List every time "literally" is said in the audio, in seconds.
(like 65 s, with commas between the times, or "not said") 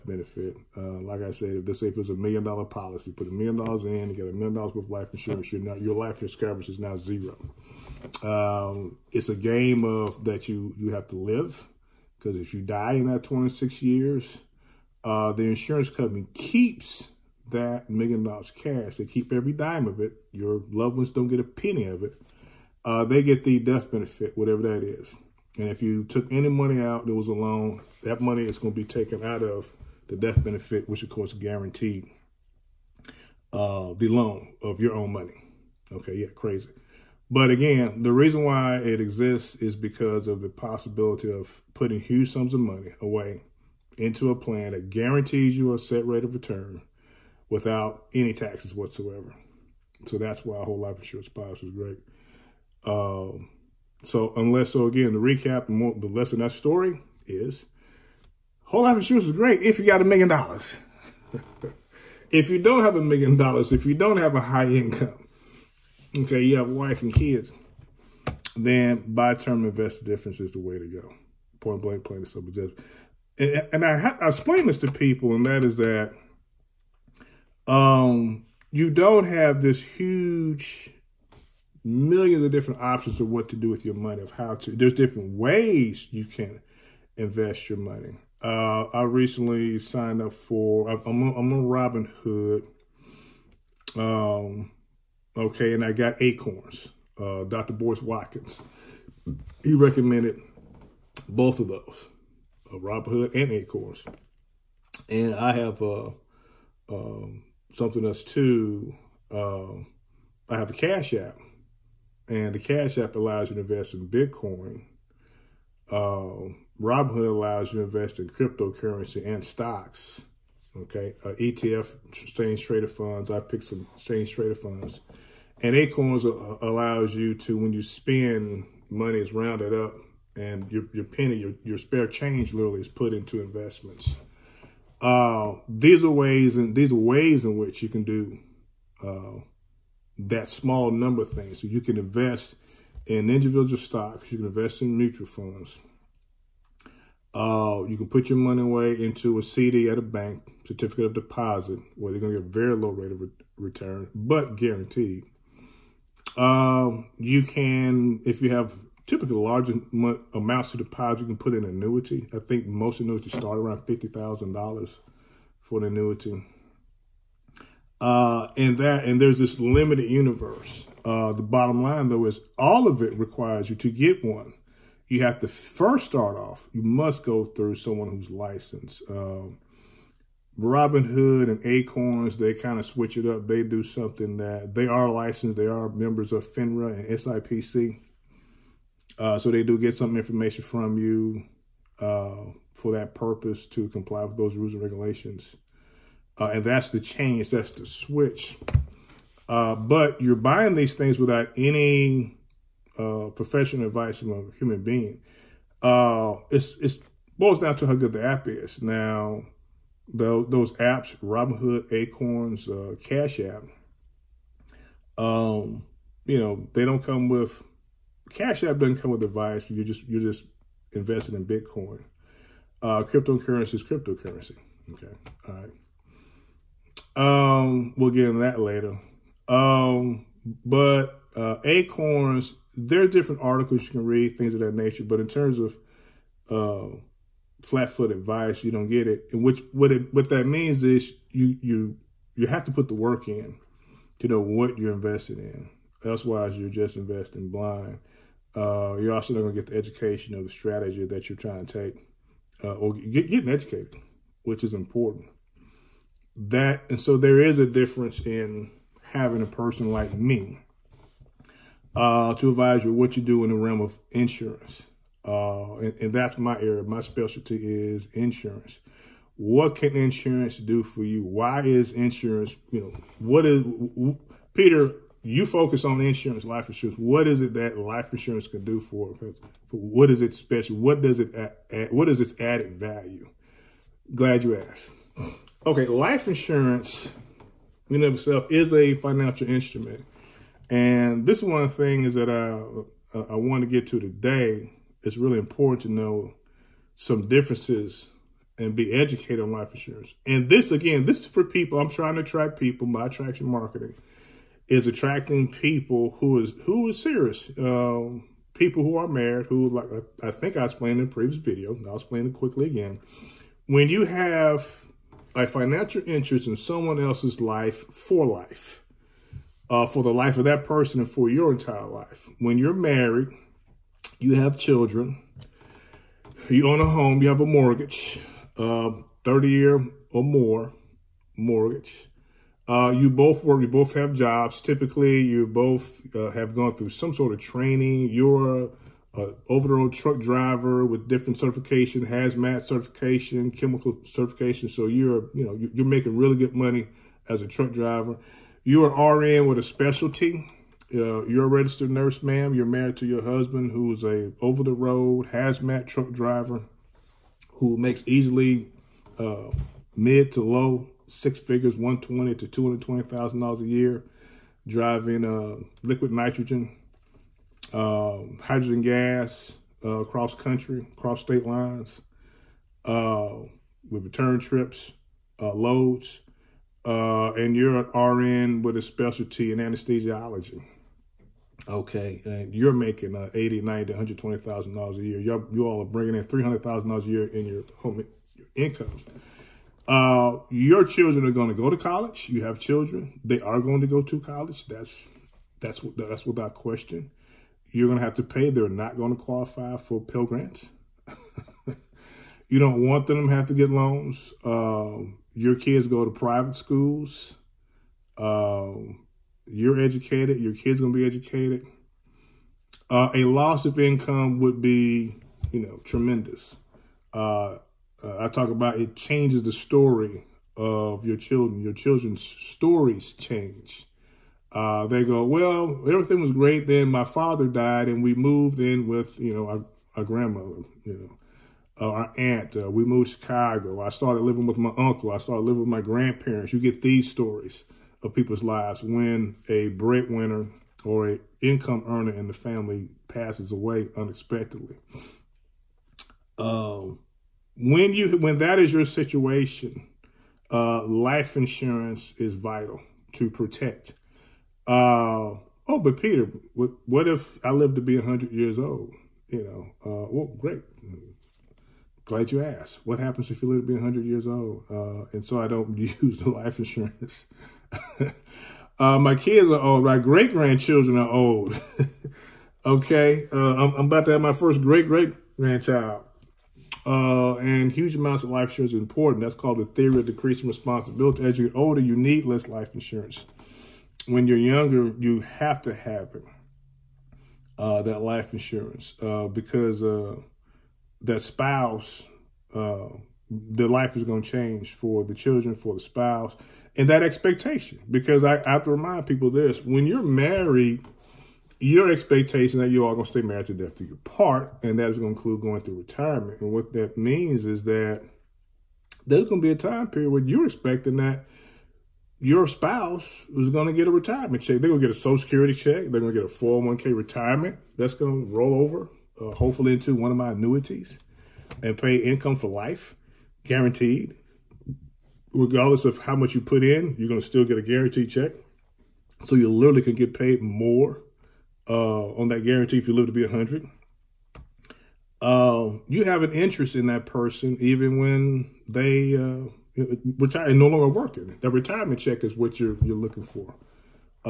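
132 s, 529 s.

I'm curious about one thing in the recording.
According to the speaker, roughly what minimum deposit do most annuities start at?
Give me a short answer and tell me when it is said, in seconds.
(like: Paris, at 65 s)
$50,000, at 163 s.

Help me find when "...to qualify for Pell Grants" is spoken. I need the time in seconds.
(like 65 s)
399 s.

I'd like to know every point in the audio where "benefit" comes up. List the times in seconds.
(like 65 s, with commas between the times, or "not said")
0 s, 23 s, 30 s.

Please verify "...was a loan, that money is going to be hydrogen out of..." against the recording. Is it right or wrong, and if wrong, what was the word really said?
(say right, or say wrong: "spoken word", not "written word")
wrong: "taken", not "hydrogen".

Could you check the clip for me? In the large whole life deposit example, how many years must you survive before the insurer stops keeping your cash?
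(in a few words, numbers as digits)
26 years.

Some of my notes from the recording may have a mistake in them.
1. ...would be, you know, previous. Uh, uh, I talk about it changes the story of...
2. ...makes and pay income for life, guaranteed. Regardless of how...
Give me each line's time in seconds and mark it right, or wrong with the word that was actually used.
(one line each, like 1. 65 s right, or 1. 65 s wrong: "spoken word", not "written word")
1. 414 s wrong: "tremendous", not "previous"
2. 520 s wrong: "annuities", not "makes".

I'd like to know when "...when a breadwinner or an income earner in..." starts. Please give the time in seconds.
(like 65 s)
438 s.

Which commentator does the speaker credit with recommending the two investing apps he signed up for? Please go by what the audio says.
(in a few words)
Dr. Boyce Watkins.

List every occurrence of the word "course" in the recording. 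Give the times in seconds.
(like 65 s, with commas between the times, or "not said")
31 s.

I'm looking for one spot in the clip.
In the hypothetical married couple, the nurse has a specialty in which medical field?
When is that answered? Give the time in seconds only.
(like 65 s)
379 s.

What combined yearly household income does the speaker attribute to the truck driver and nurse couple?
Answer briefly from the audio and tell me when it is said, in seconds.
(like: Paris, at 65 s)
$300,000, at 386 s.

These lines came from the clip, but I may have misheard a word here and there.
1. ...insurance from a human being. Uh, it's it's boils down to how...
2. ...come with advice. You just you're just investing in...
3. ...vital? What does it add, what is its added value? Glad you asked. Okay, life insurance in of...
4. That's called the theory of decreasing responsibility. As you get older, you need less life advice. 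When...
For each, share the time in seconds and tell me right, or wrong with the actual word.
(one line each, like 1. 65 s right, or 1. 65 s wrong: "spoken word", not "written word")
1. 203 s wrong: "advice", not "insurance"
2. 219 s right
3. 280 s wrong: "special", not "vital"
4. 479 s wrong: "insurance", not "advice".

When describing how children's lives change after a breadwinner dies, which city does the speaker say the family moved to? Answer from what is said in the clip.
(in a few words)
Chicago.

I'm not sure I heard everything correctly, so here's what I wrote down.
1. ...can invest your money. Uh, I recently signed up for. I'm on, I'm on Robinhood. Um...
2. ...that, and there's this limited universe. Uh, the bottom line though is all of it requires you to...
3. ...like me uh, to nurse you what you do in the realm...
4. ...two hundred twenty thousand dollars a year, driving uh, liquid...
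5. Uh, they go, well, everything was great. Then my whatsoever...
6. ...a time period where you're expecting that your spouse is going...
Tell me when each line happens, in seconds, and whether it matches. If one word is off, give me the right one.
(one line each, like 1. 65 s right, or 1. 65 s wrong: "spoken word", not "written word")
1. 86 s right
2. 168 s right
3. 259 s wrong: "advise", not "nurse"
4. 362 s right
5. 424 s wrong: "father", not "whatsoever"
6. 509 s right.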